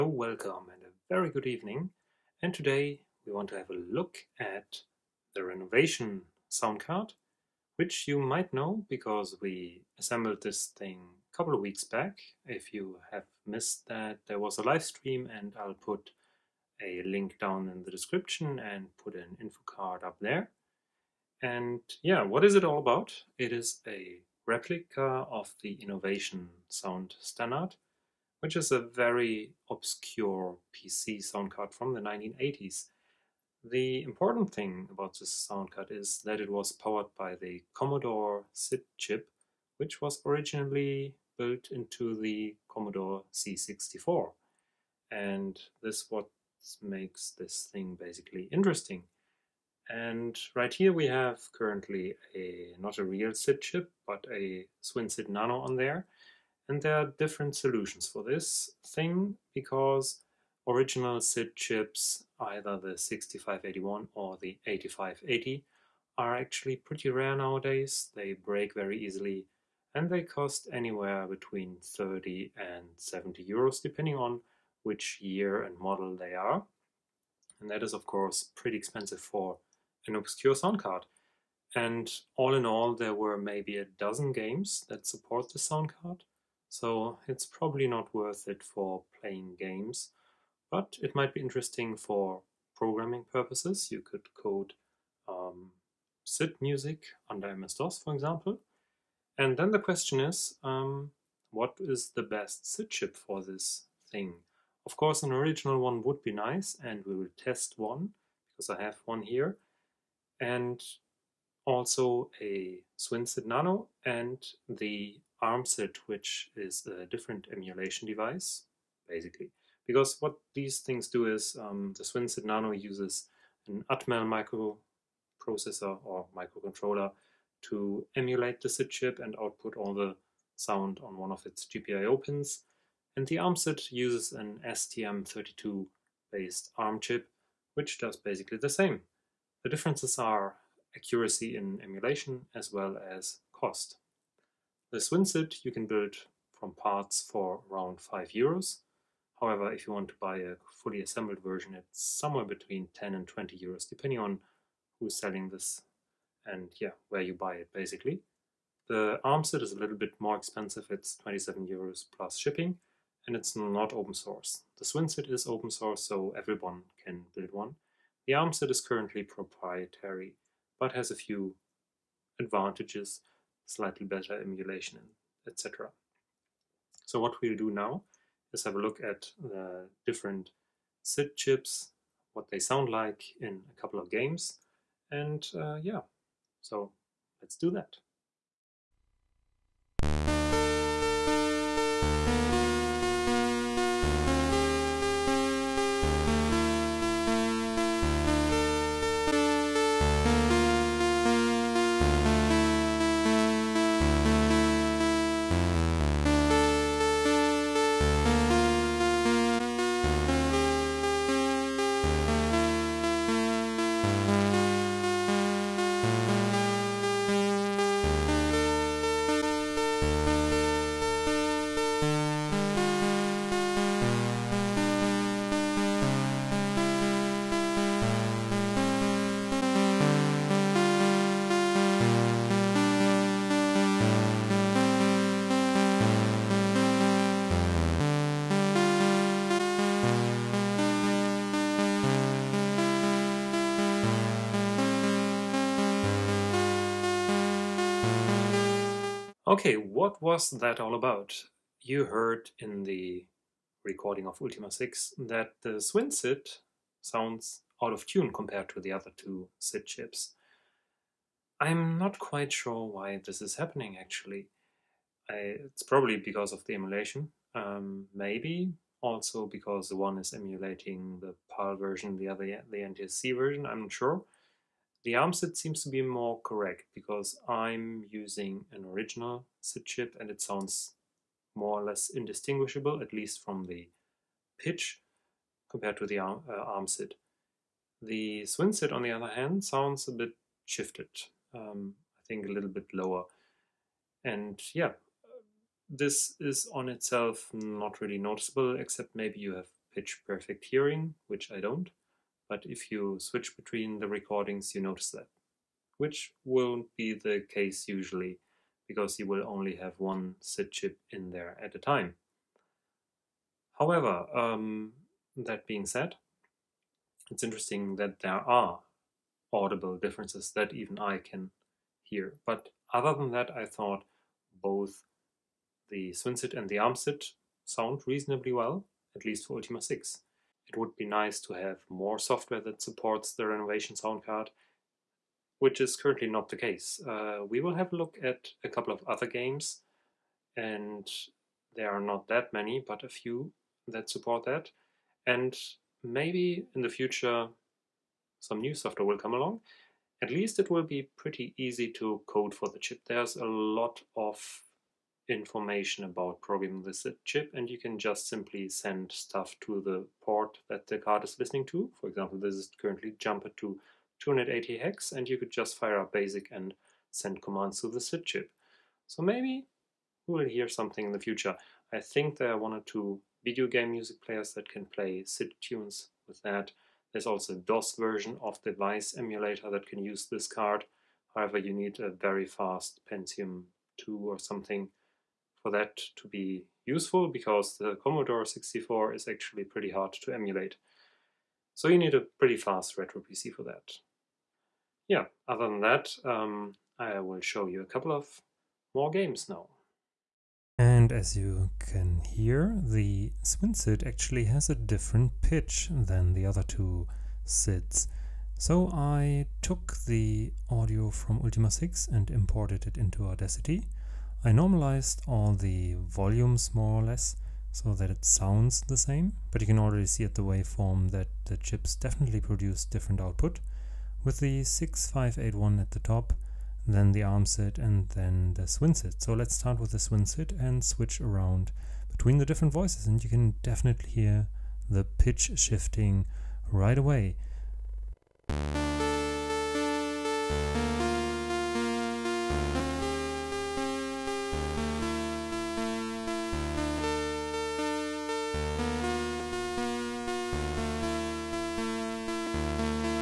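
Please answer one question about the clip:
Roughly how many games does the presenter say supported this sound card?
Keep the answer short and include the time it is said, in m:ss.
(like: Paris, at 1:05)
a dozen, at 1:23.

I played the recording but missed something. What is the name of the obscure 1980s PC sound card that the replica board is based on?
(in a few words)
Innovation Sound Standard.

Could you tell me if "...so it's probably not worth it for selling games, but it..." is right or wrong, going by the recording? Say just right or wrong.
wrong.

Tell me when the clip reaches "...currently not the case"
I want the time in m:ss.
5:35.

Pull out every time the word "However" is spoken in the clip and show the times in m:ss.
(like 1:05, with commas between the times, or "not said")
2:29, 5:13, 6:21.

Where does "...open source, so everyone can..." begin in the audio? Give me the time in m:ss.
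2:45.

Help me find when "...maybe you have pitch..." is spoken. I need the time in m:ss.
4:59.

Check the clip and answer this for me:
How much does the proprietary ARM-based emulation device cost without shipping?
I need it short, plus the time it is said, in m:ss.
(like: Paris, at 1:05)
27 euros, at 2:41.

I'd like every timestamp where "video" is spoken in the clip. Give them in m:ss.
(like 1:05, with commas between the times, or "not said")
6:13.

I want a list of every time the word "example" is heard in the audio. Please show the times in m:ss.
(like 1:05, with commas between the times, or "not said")
1:38, 6:02.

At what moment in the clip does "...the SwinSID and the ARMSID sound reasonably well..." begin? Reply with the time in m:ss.
5:25.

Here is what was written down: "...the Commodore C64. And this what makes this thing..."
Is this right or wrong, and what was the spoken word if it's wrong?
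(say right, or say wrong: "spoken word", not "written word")
right.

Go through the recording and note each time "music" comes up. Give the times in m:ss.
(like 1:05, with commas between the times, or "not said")
1:36, 6:13.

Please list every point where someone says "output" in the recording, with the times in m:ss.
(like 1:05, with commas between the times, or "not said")
2:09, 7:03.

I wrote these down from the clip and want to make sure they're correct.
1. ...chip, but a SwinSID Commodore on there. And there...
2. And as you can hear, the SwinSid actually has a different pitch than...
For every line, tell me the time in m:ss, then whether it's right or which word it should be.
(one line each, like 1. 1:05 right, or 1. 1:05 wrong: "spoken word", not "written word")
1. 0:53 wrong: "Nano", not "Commodore"
2. 6:40 right.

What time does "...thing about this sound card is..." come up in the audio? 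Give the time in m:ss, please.
0:34.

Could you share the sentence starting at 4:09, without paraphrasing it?
Okay, what was that all about?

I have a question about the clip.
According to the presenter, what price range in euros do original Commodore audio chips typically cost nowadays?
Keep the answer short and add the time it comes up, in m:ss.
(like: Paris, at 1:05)
30 to 70 euros, at 1:11.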